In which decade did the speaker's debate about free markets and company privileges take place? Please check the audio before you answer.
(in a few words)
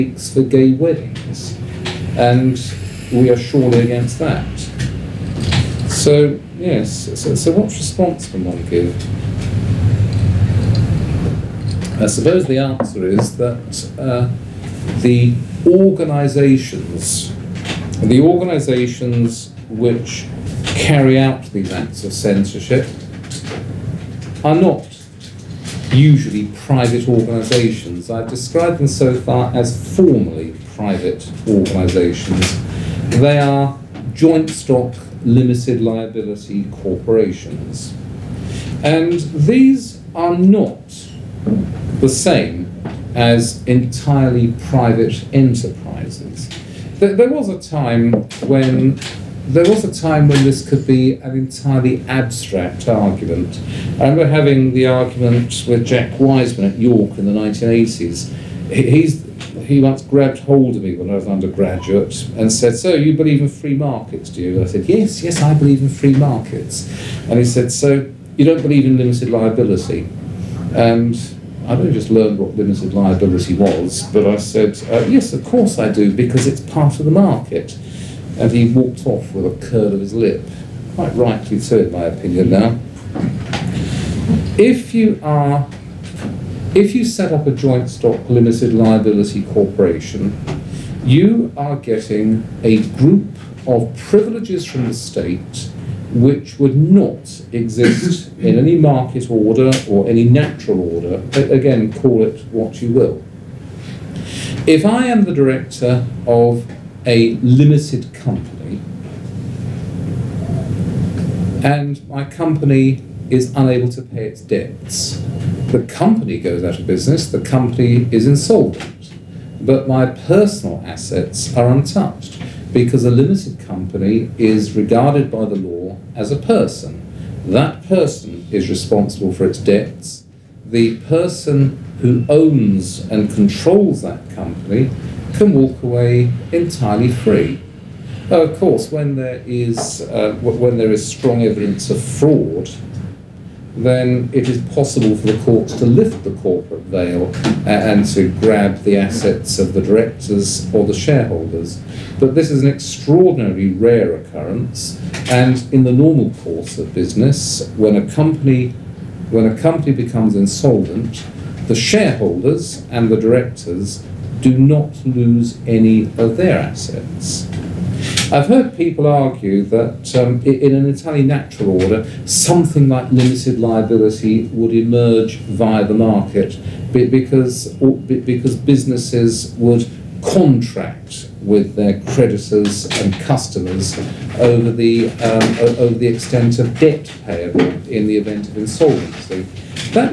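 1980s.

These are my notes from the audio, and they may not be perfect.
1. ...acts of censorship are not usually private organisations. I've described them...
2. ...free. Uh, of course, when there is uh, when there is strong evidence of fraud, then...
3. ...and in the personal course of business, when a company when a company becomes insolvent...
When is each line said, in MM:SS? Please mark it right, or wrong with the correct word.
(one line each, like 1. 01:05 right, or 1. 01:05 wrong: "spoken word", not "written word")
1. 00:21 right
2. 02:17 right
3. 02:35 wrong: "normal", not "personal".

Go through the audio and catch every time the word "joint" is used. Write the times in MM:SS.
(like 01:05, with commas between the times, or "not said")
00:34, 01:27.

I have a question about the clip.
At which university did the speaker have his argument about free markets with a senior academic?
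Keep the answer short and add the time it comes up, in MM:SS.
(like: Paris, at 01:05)
York, at 00:56.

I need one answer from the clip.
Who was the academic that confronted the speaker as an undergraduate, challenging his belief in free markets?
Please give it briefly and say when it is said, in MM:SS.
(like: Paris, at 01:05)
Jack Wiseman, at 00:55.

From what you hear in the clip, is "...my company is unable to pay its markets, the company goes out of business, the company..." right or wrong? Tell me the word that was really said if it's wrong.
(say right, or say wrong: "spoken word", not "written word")
wrong: "debts", not "markets".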